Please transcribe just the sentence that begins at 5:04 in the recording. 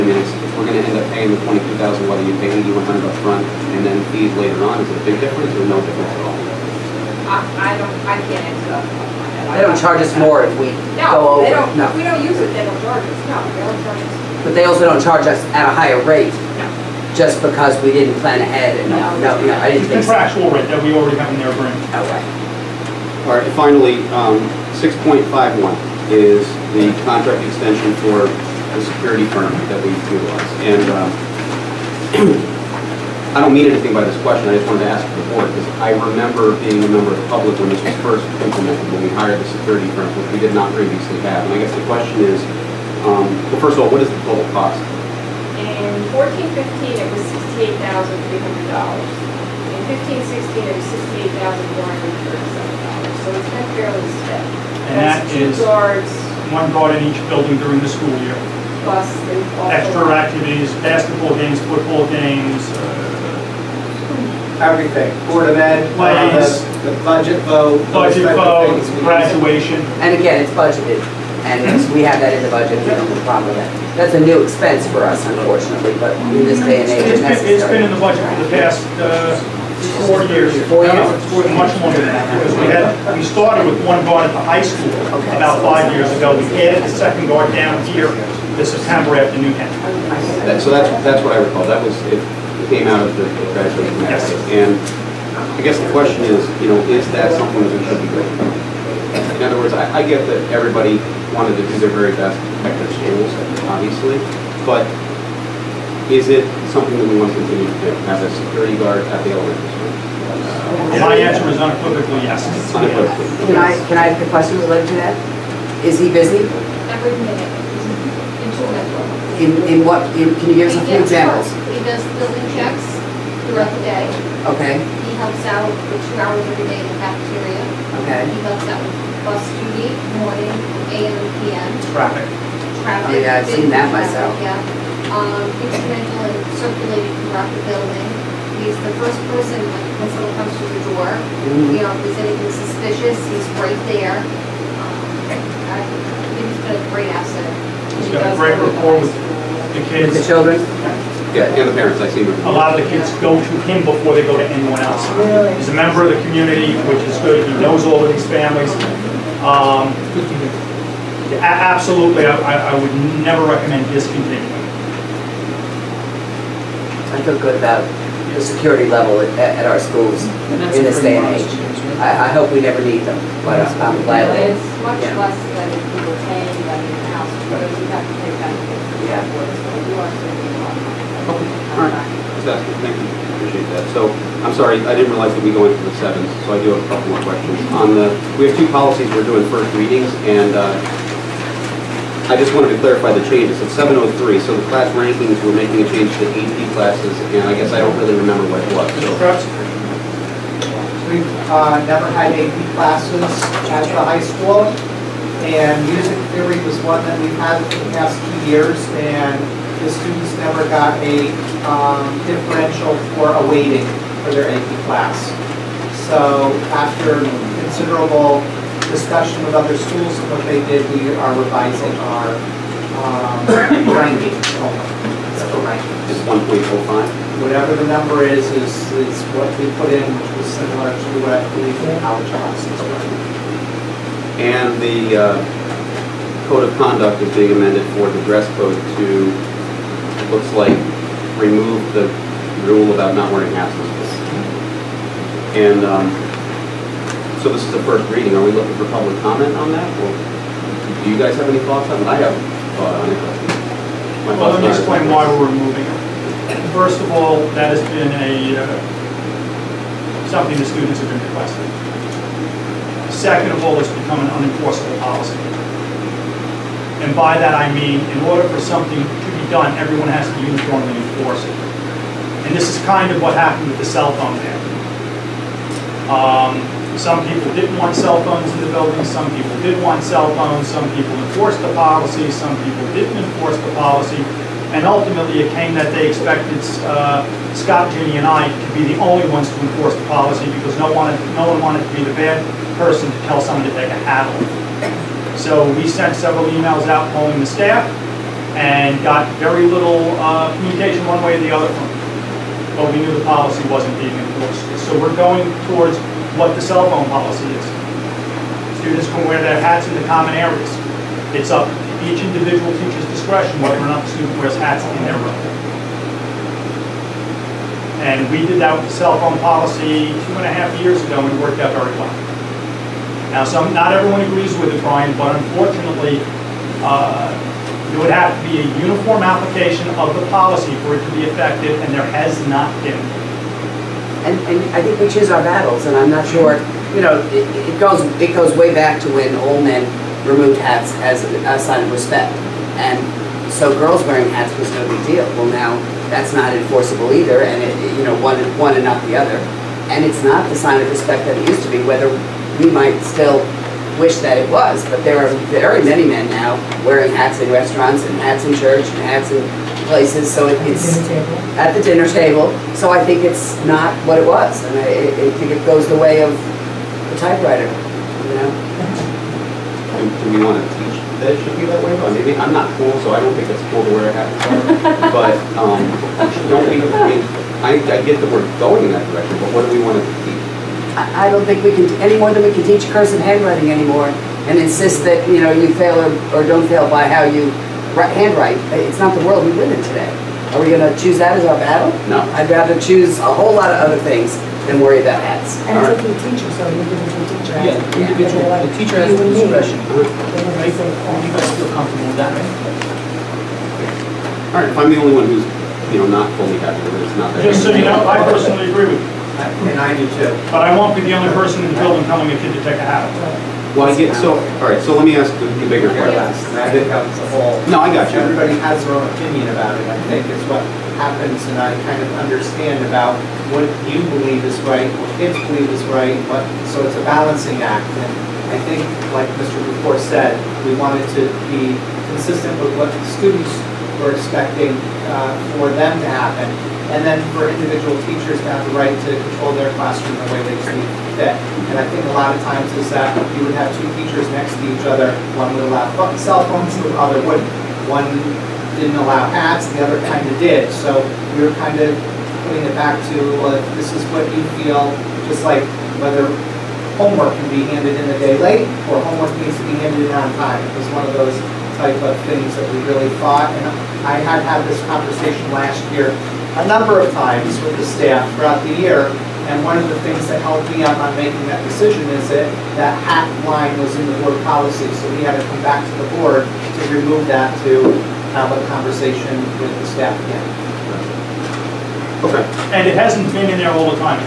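So we're going towards what the cell phone policy is.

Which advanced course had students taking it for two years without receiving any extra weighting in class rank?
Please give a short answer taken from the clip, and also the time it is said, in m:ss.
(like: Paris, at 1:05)
Music theory, at 3:25.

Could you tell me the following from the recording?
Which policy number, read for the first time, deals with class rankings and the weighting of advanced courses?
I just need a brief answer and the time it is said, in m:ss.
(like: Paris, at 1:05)
703, at 3:13.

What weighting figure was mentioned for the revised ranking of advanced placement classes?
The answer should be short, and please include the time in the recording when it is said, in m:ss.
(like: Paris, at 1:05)
1.45, at 3:46.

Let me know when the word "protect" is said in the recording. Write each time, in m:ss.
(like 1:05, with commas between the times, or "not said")
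1:42.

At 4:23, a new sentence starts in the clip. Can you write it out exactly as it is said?
Second of all, it's become an unenforceable policy.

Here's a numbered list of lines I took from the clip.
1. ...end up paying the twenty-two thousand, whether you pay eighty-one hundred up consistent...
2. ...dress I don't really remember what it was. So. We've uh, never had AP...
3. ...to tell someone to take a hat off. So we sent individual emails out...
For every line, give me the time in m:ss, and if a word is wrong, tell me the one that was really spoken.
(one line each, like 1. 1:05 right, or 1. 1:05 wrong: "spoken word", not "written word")
1. 0:00 wrong: "front", not "consistent"
2. 3:17 wrong: "guess", not "dress"
3. 4:53 wrong: "several", not "individual".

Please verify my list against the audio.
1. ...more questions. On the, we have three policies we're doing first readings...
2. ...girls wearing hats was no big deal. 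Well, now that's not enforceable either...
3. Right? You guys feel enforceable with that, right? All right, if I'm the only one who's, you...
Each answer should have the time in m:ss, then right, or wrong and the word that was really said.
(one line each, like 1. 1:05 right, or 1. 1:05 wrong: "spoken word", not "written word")
1. 3:07 wrong: "two", not "three"
2. 5:43 right
3. 6:39 wrong: "comfortable", not "enforceable".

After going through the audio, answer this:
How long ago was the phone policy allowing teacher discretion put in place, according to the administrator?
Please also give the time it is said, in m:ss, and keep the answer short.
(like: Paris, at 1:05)
2.5 years, at 5:20.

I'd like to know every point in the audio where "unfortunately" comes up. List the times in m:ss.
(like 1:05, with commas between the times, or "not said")
1:15, 5:25.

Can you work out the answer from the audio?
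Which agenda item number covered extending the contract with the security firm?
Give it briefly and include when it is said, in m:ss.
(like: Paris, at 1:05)
6.51, at 0:24.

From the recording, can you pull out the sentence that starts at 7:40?
It was one of those type of things that we really thought.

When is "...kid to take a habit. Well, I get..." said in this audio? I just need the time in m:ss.
6:52.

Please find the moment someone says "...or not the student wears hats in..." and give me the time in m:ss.
5:13.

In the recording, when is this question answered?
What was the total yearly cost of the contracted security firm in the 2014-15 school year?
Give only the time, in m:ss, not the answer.
0:47.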